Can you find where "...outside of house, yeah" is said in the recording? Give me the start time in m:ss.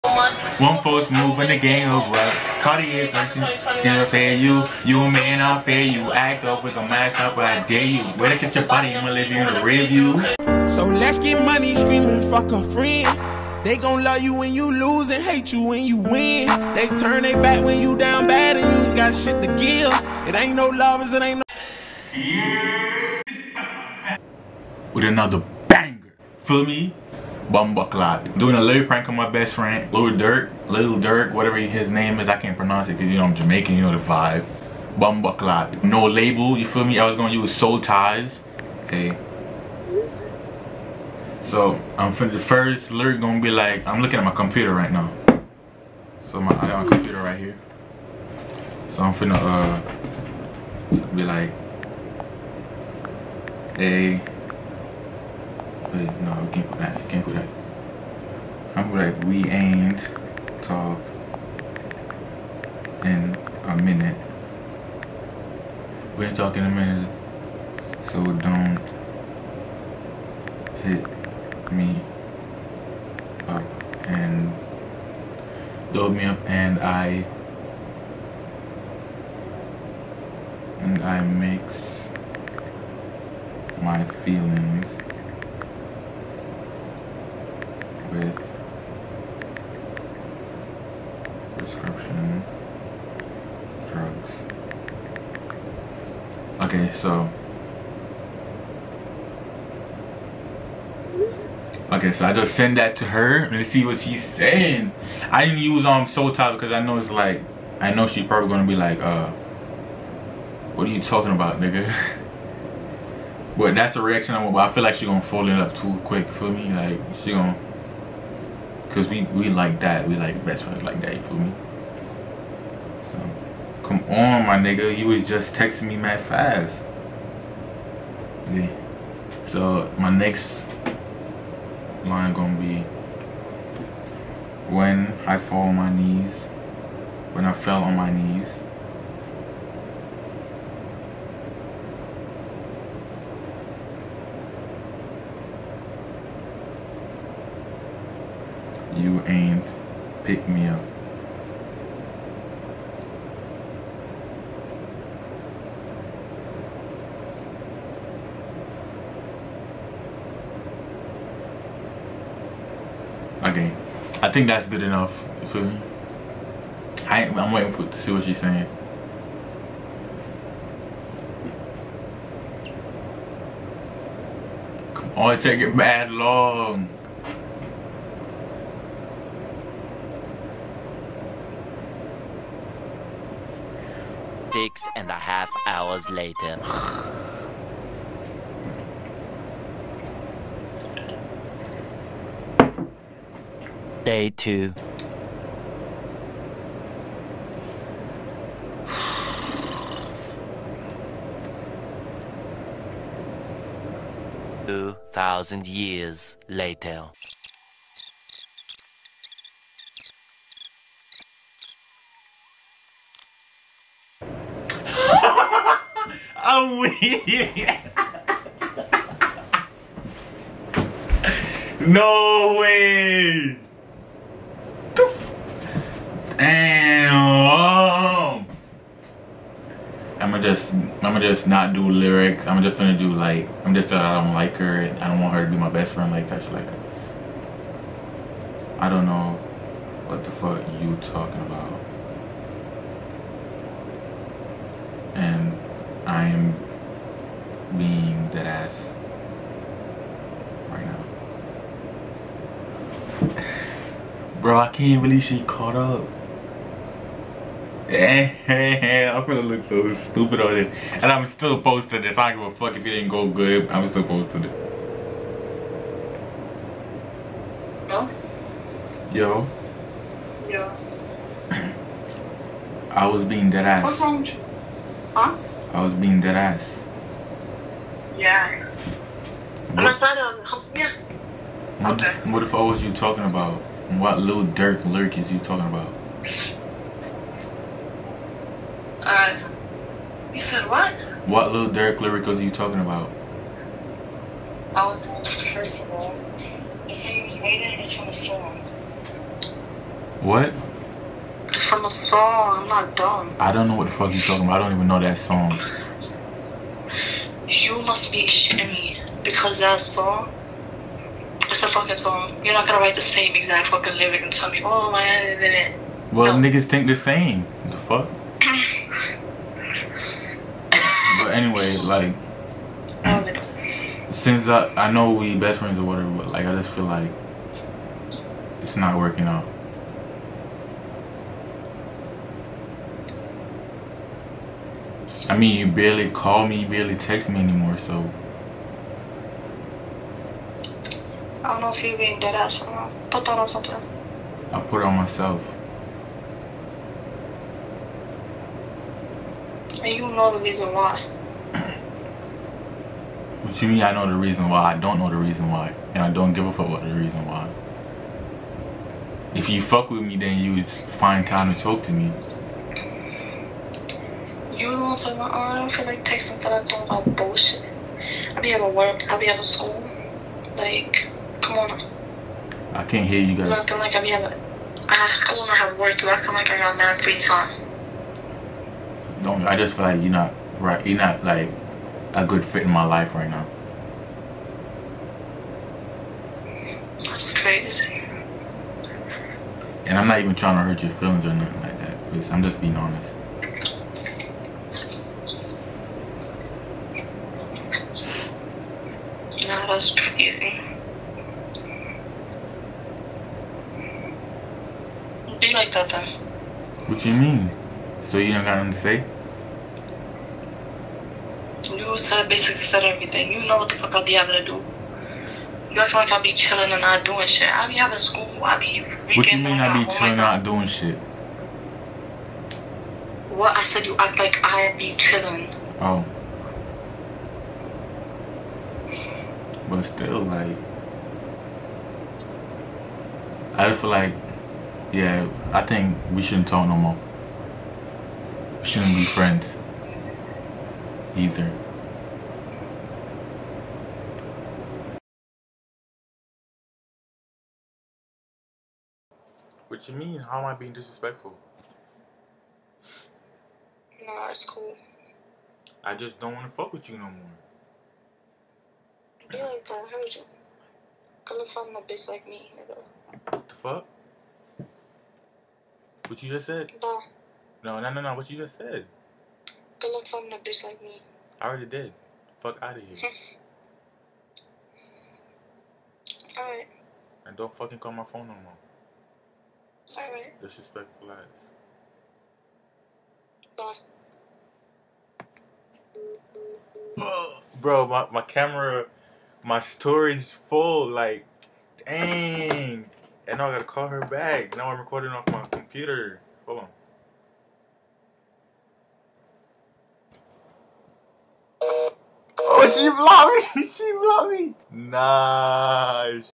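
4:39.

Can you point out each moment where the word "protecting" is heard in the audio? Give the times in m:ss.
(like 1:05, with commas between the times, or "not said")
not said.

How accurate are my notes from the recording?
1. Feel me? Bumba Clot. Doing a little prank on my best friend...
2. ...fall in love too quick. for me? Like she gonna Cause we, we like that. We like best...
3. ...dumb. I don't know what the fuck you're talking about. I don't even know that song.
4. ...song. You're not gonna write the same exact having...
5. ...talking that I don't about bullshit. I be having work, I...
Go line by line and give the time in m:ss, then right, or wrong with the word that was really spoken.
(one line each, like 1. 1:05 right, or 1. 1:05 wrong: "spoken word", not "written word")
1. 0:26 right
2. 1:55 right
3. 5:02 right
4. 5:11 wrong: "fucking", not "having"
5. 6:06 wrong: "texting", not "talking".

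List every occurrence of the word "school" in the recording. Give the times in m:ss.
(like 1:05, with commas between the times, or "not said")
6:09, 6:15, 6:57.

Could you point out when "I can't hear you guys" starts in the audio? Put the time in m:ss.
6:12.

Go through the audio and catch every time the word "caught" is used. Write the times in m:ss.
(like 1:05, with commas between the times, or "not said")
4:15.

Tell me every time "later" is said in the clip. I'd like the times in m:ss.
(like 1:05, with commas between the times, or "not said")
3:06, 3:26.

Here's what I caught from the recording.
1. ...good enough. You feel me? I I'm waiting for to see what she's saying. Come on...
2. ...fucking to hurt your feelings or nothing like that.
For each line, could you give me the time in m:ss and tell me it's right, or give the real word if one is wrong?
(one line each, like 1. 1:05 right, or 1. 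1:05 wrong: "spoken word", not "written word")
1. 2:44 right
2. 6:30 wrong: "trying", not "fucking".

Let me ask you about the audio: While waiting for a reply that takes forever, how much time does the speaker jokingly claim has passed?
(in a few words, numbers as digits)
2000 years.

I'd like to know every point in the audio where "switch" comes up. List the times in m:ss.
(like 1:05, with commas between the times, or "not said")
not said.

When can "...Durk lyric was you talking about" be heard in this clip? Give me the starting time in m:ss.
4:51.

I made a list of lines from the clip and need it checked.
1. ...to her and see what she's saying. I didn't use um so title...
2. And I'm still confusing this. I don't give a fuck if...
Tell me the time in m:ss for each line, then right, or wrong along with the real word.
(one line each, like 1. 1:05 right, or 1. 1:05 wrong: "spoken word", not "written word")
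1. 1:42 right
2. 4:20 wrong: "posting", not "confusing".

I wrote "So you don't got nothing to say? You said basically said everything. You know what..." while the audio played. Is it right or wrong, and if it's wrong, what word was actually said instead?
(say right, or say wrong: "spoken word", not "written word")
right.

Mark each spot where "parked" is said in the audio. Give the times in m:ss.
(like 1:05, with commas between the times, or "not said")
not said.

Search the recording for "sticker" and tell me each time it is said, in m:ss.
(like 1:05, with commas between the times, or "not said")
not said.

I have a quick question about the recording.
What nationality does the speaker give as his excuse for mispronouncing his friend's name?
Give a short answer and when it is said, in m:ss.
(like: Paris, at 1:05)
Jamaican, at 0:33.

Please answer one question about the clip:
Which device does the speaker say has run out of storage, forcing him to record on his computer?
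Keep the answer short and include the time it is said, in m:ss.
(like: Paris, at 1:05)
camera, at 8:08.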